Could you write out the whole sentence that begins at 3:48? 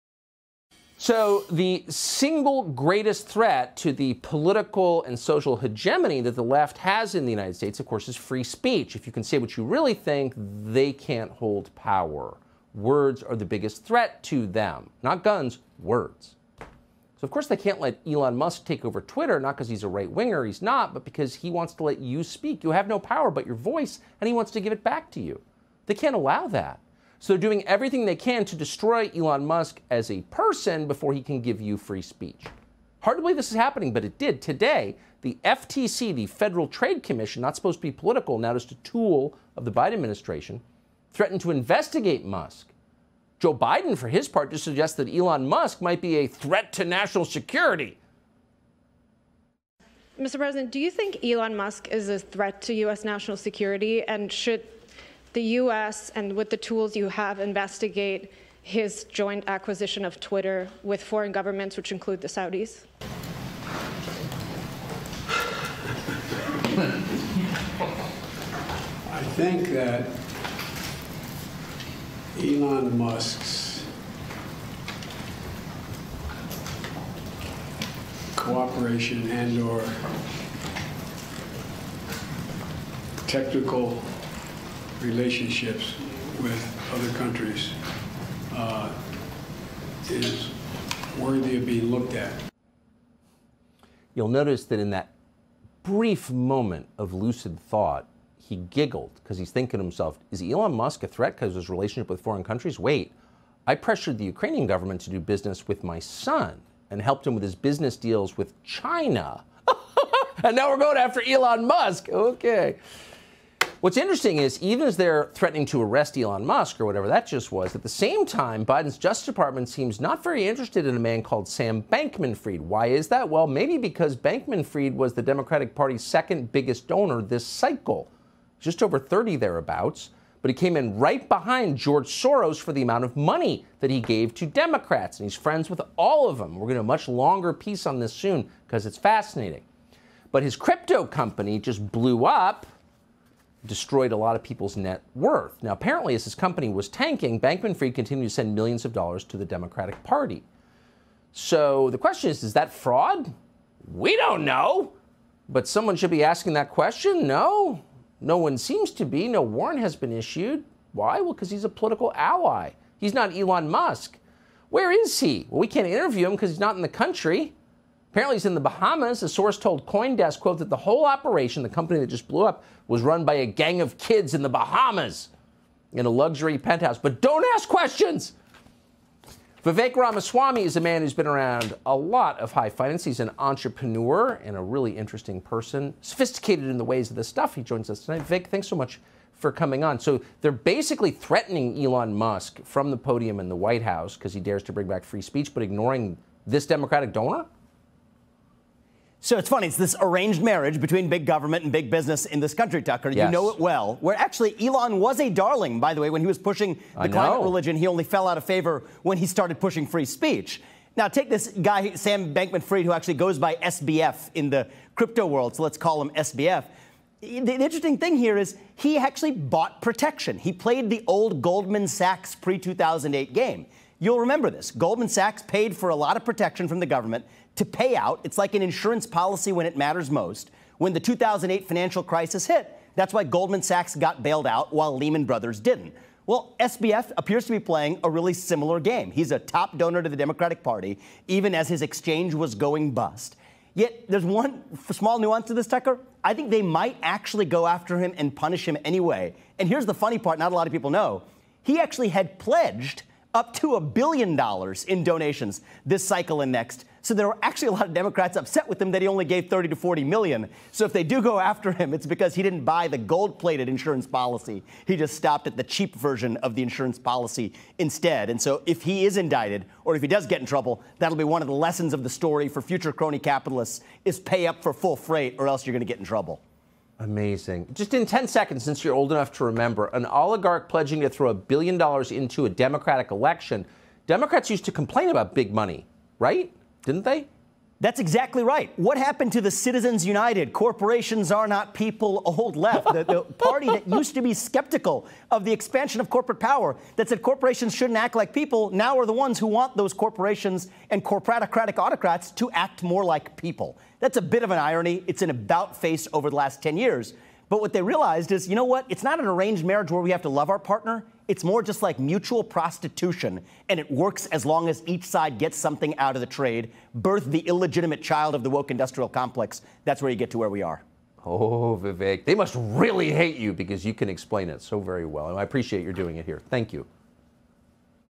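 It's like an insurance policy when it matters most.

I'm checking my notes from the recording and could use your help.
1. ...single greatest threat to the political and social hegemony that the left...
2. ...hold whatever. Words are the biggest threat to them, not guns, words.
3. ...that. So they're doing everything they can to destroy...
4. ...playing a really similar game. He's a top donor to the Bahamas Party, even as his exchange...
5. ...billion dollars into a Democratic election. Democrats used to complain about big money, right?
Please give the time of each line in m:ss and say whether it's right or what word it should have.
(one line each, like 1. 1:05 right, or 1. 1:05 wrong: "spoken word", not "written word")
1. 0:01 right
2. 0:11 wrong: "power", not "whatever"
3. 0:26 right
4. 3:57 wrong: "Democratic", not "Bahamas"
5. 4:41 right.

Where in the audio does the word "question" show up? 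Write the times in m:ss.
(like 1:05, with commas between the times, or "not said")
2:31, 2:36, 2:57.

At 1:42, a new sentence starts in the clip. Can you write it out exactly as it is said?
Wait, I pressured the Ukrainian government to do business with my son and helped him with his business deals with China.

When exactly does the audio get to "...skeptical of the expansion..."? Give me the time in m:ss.
4:54.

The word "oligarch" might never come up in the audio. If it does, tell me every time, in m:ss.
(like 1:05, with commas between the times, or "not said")
4:40.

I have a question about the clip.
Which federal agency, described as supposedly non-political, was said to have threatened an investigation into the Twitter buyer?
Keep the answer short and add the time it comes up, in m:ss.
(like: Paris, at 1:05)
Federal Trade Commission, at 0:36.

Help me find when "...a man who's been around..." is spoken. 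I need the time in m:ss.
3:00.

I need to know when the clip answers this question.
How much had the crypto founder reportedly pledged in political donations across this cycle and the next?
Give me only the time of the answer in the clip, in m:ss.
4:13.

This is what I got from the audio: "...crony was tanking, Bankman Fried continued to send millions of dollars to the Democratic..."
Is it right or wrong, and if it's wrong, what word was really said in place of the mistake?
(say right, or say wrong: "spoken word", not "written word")
wrong: "company", not "crony".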